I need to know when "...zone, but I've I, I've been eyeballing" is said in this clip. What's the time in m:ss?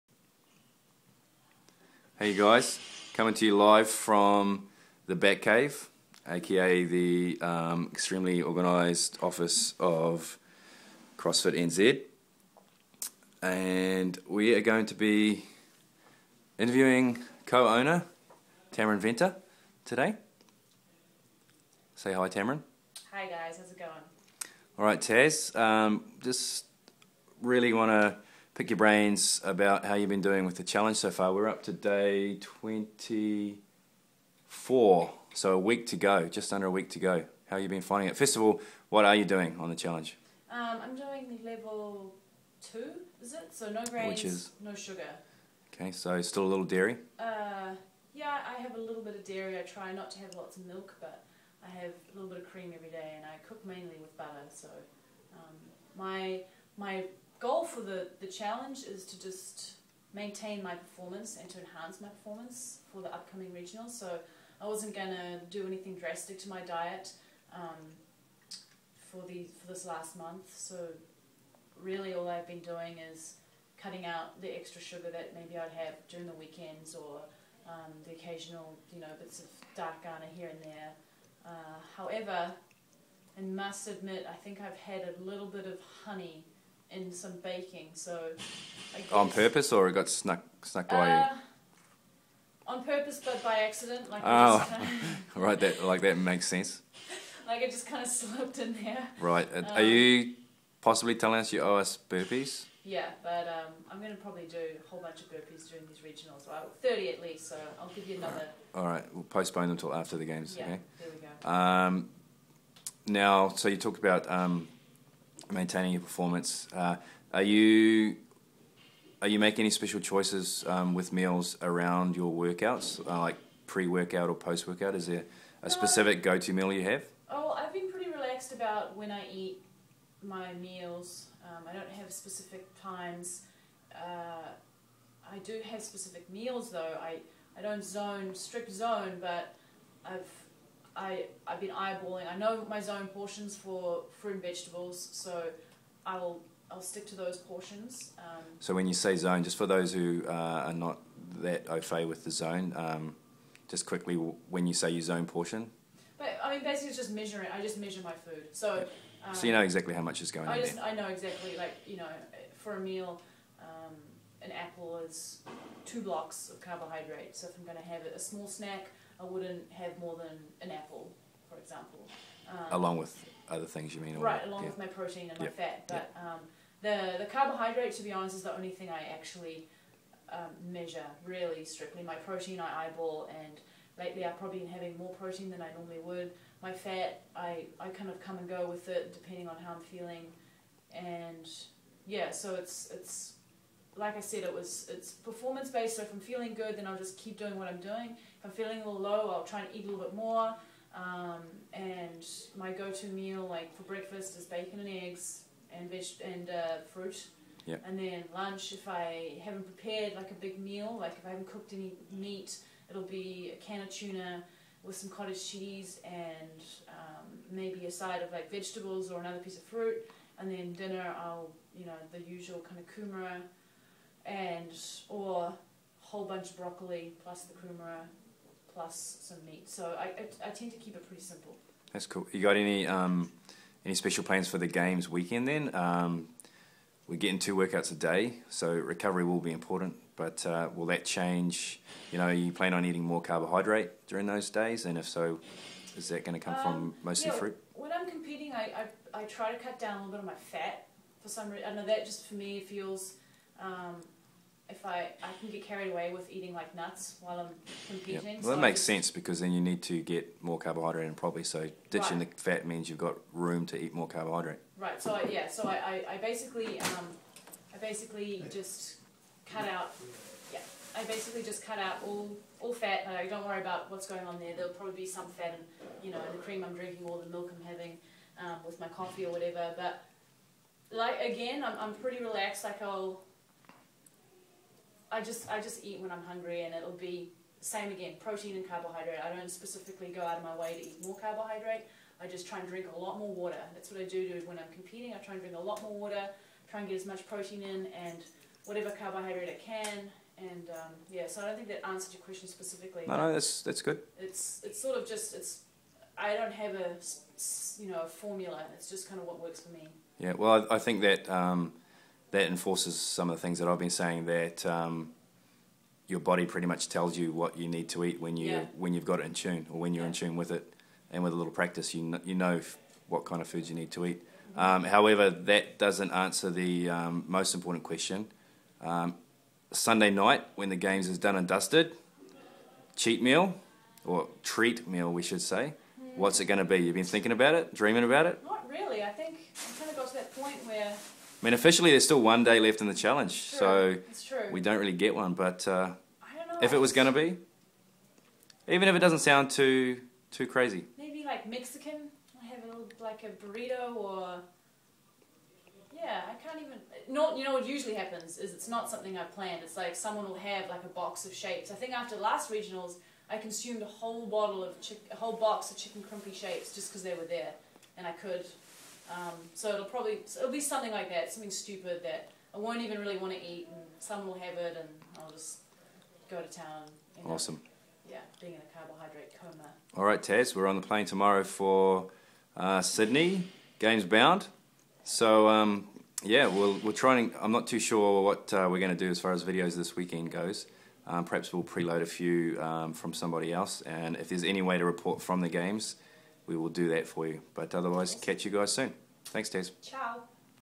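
2:18.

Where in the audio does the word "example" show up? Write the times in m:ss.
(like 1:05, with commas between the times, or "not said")
2:51.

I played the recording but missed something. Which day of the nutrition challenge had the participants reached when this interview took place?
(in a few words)
24.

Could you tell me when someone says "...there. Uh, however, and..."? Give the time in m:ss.
1:20.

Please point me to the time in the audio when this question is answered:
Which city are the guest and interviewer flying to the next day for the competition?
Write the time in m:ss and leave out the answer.
6:22.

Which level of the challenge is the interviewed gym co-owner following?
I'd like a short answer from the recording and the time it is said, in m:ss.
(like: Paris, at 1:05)
level two, at 0:41.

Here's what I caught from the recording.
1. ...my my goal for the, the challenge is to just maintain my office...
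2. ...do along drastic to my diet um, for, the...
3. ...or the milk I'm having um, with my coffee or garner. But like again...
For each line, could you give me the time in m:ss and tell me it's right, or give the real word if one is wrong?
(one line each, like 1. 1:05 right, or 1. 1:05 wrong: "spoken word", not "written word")
1. 0:55 wrong: "performance", not "office"
2. 1:05 wrong: "anything", not "along"
3. 4:37 wrong: "whatever", not "garner".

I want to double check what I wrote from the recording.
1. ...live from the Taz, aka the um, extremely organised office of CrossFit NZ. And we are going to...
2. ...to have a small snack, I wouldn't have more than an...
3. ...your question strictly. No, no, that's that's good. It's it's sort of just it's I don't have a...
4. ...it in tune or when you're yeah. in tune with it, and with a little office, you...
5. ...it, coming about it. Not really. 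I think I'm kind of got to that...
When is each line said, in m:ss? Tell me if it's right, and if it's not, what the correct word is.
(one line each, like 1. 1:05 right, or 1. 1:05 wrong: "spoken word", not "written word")
1. 0:03 wrong: "Batcave", not "Taz"
2. 2:47 right
3. 5:02 wrong: "specifically", not "strictly"
4. 5:19 wrong: "practice", not "office"
5. 5:37 wrong: "dreaming", not "coming".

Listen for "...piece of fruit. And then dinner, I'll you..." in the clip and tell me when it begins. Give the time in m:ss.
3:39.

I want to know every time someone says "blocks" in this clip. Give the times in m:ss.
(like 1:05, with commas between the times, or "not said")
2:46.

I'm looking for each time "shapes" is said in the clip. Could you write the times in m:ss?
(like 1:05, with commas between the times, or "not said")
6:01, 6:06.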